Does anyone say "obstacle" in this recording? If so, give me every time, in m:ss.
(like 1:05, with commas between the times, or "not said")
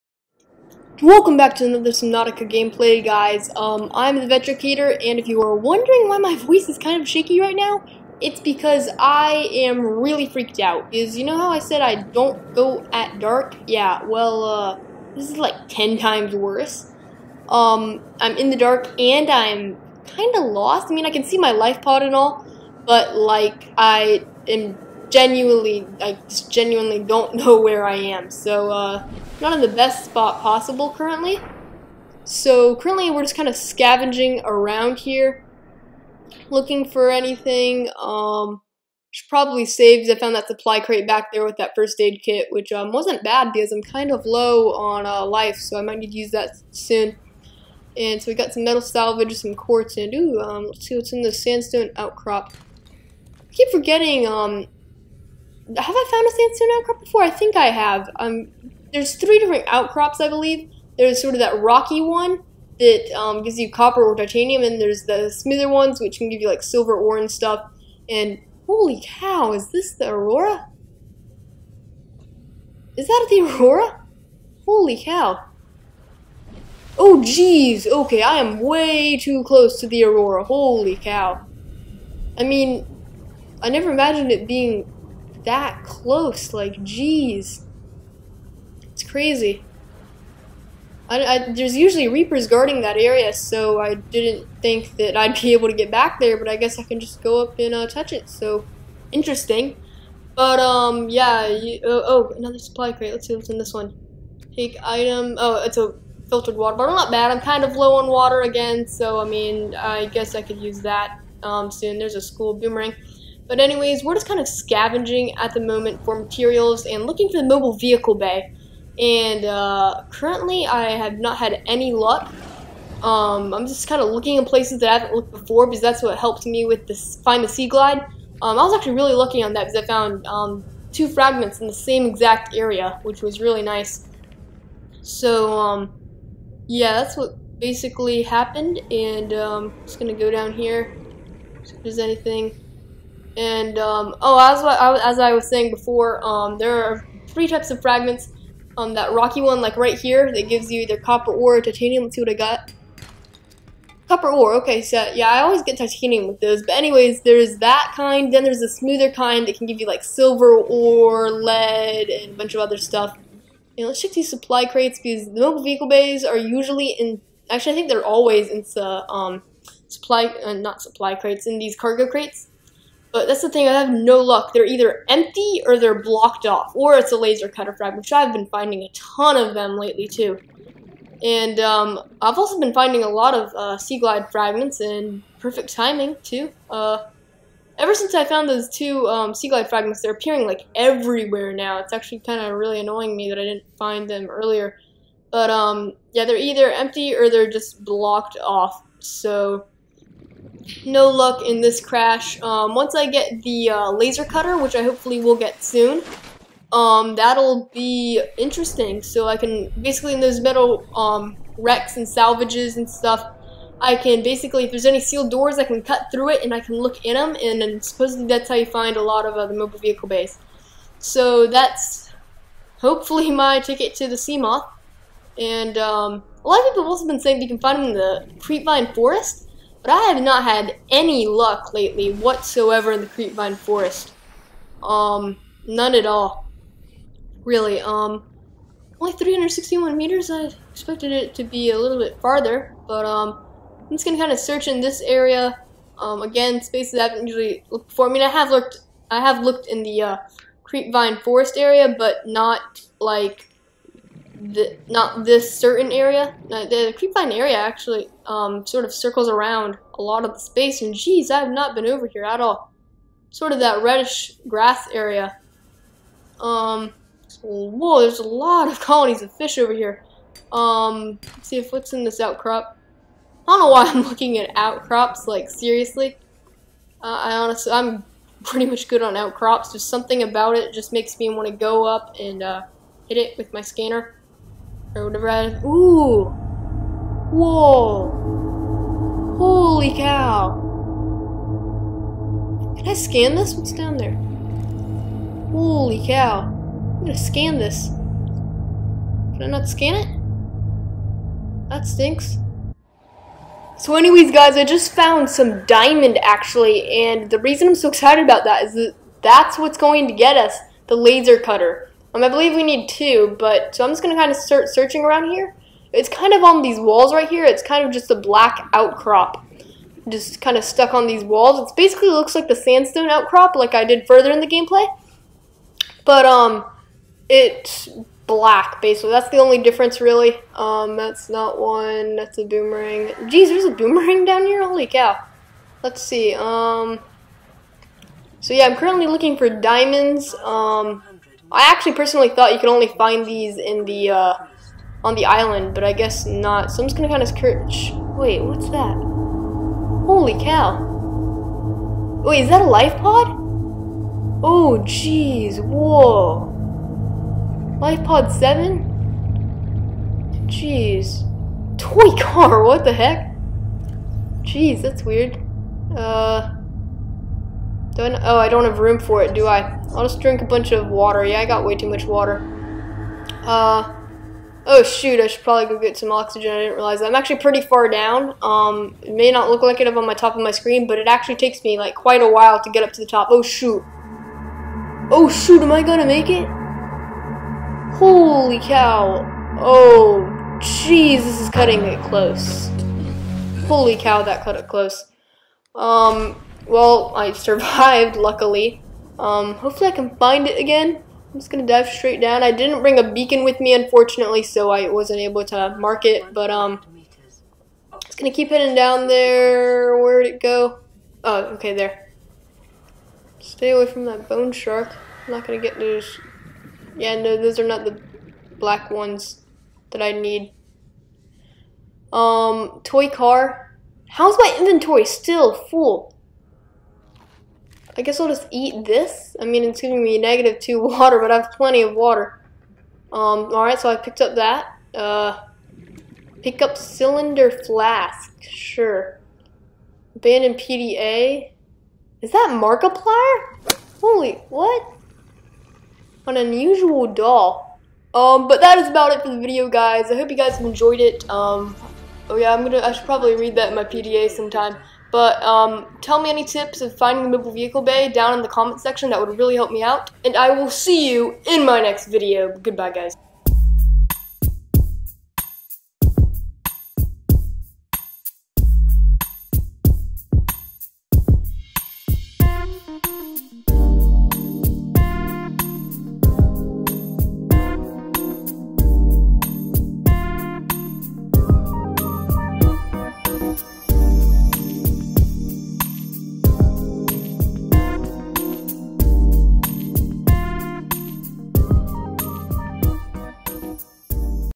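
not said.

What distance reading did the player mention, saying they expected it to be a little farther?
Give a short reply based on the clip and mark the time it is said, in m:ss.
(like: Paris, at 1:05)
361 meters, at 3:59.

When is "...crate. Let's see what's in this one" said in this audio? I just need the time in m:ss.
1:42.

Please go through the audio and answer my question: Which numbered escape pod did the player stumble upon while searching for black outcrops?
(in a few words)
Life pod 7.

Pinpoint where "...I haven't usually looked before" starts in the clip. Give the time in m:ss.
4:06.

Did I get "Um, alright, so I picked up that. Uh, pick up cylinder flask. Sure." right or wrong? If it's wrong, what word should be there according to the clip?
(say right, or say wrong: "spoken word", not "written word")
right.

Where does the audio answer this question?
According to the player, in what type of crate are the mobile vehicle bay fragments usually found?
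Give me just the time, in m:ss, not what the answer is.
2:51.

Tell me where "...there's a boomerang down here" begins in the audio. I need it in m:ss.
5:33.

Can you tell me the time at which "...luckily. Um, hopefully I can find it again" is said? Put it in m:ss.
6:38.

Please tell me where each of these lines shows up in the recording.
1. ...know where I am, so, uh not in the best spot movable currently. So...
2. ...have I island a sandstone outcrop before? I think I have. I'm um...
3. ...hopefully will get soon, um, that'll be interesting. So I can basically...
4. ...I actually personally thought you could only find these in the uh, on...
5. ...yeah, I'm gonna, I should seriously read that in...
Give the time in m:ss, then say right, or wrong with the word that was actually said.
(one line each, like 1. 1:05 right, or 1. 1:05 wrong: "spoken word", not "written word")
1. 0:27 wrong: "possible", not "movable"
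2. 0:55 wrong: "found", not "island"
3. 3:24 right
4. 5:41 right
5. 7:32 wrong: "probably", not "seriously".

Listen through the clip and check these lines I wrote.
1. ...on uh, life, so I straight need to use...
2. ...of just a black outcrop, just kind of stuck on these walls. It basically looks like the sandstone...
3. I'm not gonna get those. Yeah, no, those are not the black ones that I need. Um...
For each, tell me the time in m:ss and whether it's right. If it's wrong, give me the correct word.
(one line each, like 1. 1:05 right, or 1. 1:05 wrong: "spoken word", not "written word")
1. 0:44 wrong: "might", not "straight"
2. 5:17 right
3. 6:55 right.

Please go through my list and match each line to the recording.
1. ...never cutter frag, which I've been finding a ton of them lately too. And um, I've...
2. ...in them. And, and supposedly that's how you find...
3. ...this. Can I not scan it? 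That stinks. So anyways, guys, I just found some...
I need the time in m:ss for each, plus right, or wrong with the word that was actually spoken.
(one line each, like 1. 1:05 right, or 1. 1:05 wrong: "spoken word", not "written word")
1. 2:57 wrong: "laser", not "never"
2. 3:37 right
3. 4:57 right.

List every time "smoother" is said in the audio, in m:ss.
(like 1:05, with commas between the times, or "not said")
1:05, 2:38.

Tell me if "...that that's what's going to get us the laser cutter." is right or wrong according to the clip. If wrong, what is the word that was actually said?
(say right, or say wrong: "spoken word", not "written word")
right.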